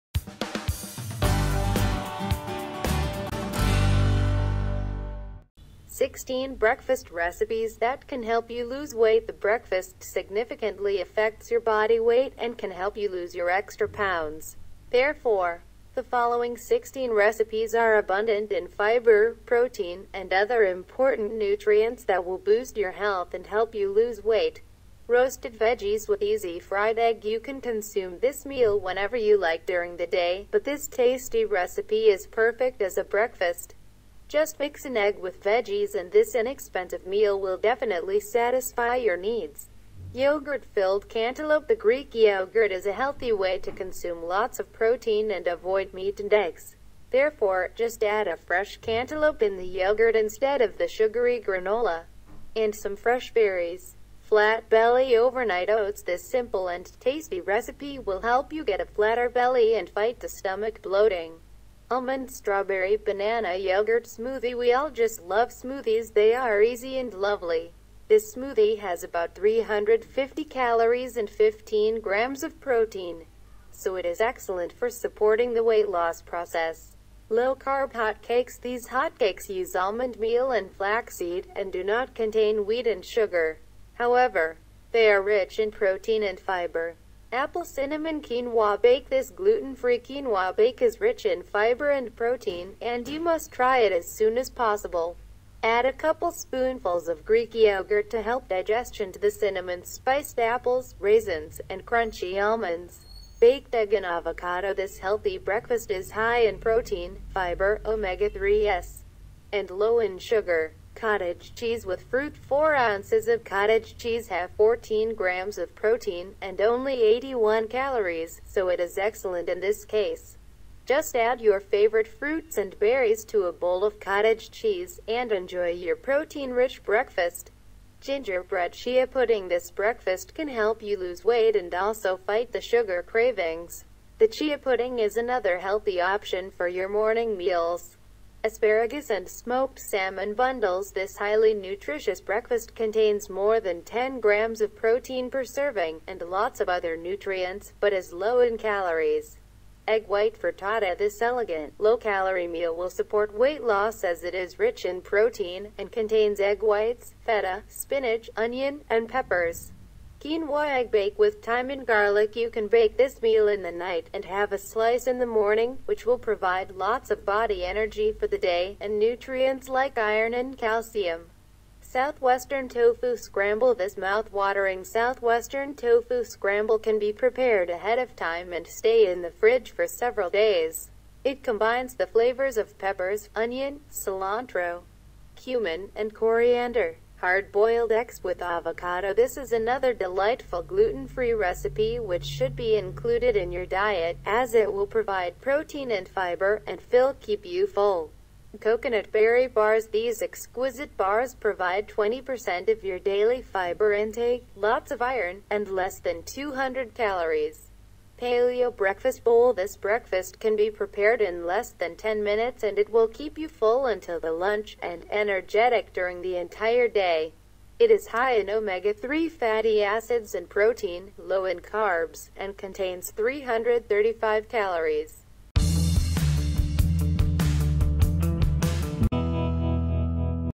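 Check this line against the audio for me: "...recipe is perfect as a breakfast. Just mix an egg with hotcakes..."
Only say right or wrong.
wrong.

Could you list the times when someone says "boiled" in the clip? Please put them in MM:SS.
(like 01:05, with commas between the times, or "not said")
03:07.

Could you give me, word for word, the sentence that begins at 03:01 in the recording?
It combines the flavors of peppers, onion, cilantro, cumin, and coriander.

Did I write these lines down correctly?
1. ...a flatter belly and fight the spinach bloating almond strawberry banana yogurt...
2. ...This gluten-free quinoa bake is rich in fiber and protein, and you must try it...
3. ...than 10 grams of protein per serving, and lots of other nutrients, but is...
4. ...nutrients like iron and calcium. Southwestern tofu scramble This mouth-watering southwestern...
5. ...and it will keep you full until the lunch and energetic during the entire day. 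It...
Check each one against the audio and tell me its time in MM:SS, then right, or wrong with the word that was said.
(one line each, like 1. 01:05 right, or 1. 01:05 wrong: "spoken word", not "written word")
1. 00:58 wrong: "stomach", not "spinach"
2. 01:29 right
3. 02:23 right
4. 02:48 right
5. 03:32 right.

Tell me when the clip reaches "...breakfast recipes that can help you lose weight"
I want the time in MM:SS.
00:06.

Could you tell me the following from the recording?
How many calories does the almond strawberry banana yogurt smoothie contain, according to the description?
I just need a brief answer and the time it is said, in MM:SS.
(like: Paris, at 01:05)
350, at 01:09.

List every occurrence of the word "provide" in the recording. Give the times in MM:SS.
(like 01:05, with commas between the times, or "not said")
02:46, 03:14, 03:21.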